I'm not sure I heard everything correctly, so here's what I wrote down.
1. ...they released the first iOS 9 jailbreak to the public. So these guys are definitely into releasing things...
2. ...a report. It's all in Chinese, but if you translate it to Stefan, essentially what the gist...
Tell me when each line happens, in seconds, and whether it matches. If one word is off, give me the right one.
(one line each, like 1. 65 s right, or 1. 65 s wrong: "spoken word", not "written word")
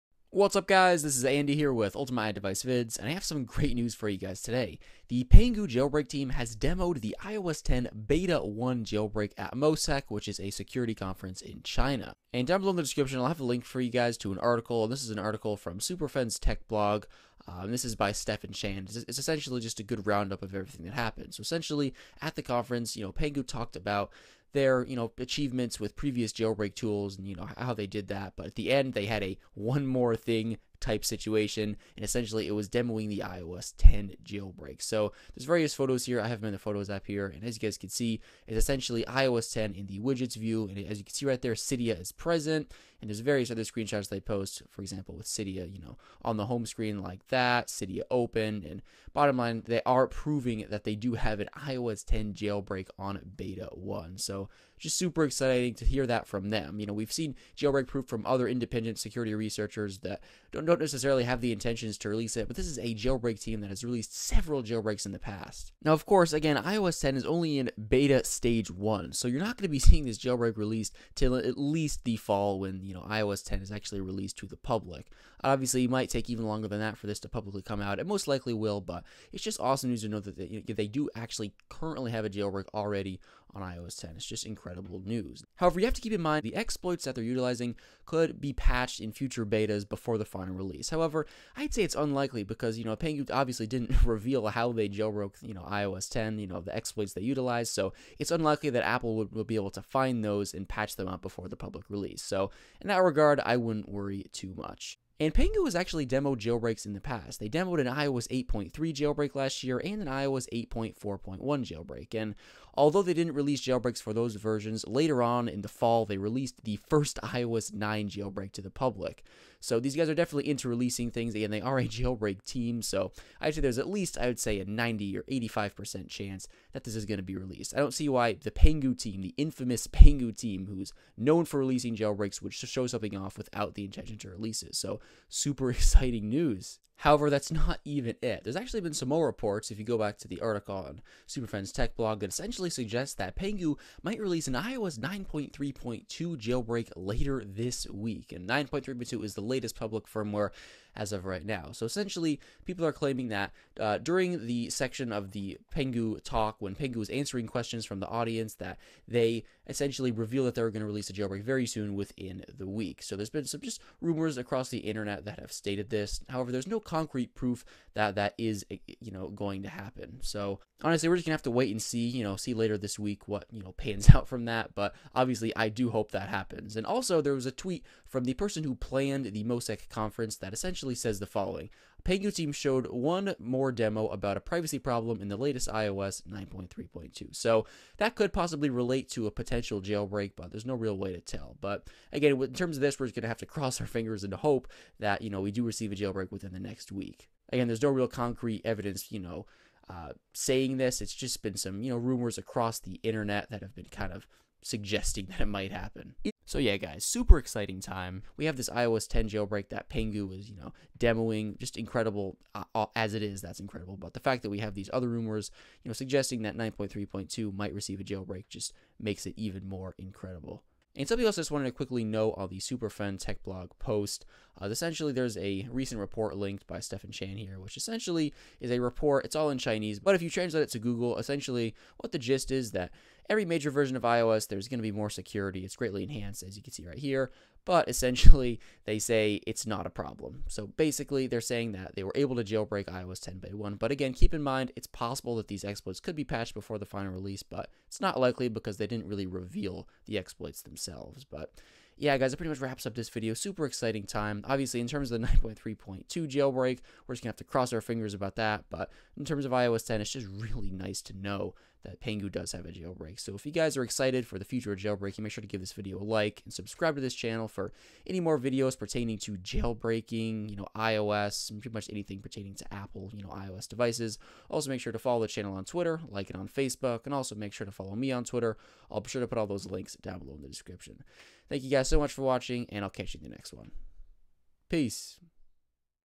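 1. 116 s right
2. 228 s wrong: "Google", not "Stefan".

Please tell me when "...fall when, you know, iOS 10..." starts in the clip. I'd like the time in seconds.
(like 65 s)
72 s.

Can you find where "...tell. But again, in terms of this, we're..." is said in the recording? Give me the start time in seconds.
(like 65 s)
191 s.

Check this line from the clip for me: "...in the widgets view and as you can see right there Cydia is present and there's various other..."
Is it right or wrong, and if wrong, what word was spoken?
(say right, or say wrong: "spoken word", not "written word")
right.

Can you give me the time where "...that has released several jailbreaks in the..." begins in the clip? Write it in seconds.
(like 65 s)
63 s.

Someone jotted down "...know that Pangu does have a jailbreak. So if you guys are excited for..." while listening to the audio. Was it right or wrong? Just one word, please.
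right.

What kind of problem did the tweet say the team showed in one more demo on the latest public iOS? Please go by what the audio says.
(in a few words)
privacy problem.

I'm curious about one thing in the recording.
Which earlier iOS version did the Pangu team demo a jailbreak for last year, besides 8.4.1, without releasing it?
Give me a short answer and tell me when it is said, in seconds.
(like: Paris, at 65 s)
iOS 8.3, at 107 s.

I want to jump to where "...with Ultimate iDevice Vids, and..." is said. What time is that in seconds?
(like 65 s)
1 s.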